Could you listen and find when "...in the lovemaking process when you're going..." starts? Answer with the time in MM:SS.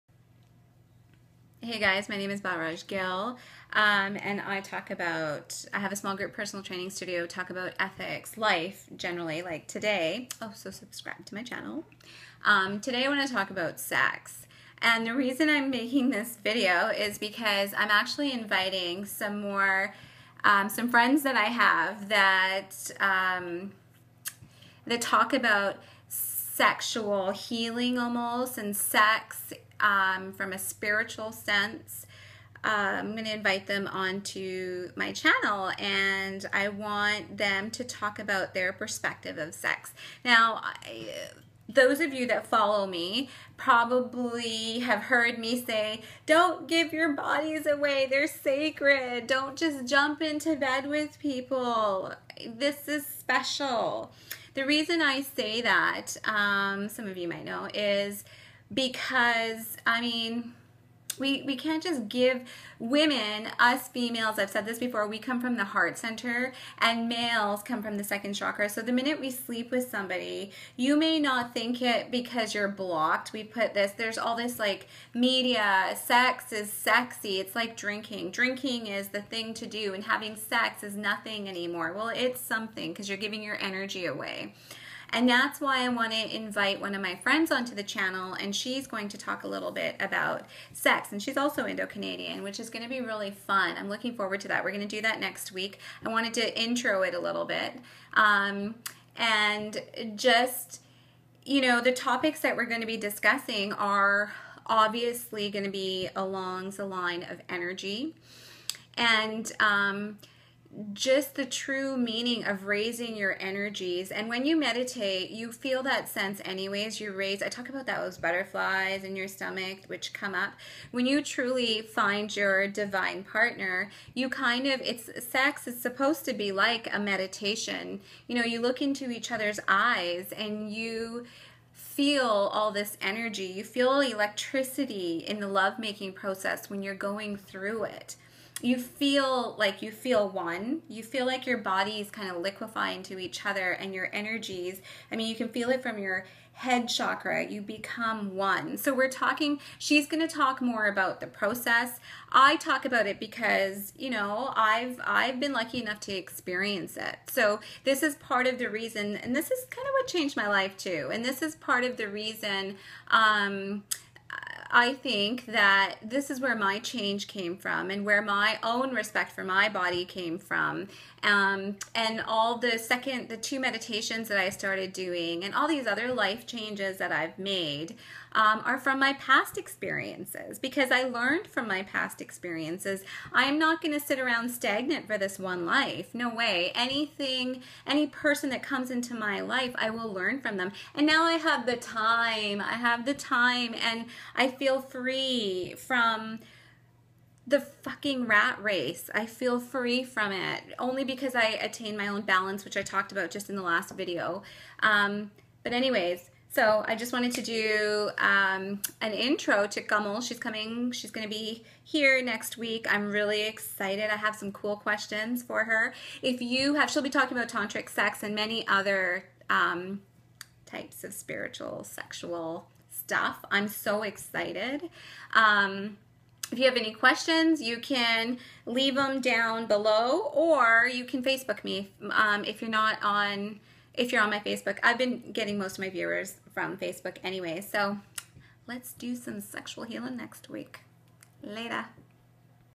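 02:15.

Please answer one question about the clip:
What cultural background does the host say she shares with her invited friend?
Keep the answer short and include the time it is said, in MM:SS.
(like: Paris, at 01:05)
Indo Canadian, at 01:31.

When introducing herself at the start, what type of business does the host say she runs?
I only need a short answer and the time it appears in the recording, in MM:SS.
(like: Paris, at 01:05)
Small group personal training studio, at 00:05.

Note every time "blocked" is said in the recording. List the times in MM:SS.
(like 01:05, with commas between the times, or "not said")
01:12.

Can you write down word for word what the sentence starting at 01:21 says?
Well, it's something because you're giving your energy away.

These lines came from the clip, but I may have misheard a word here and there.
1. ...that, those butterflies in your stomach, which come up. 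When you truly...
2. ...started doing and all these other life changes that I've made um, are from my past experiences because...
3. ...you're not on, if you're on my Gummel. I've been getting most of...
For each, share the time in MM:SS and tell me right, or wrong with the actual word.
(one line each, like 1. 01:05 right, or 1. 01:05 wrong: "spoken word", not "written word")
1. 01:57 right
2. 02:54 right
3. 03:52 wrong: "Facebook", not "Gummel".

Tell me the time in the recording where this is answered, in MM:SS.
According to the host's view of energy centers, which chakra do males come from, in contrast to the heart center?
01:08.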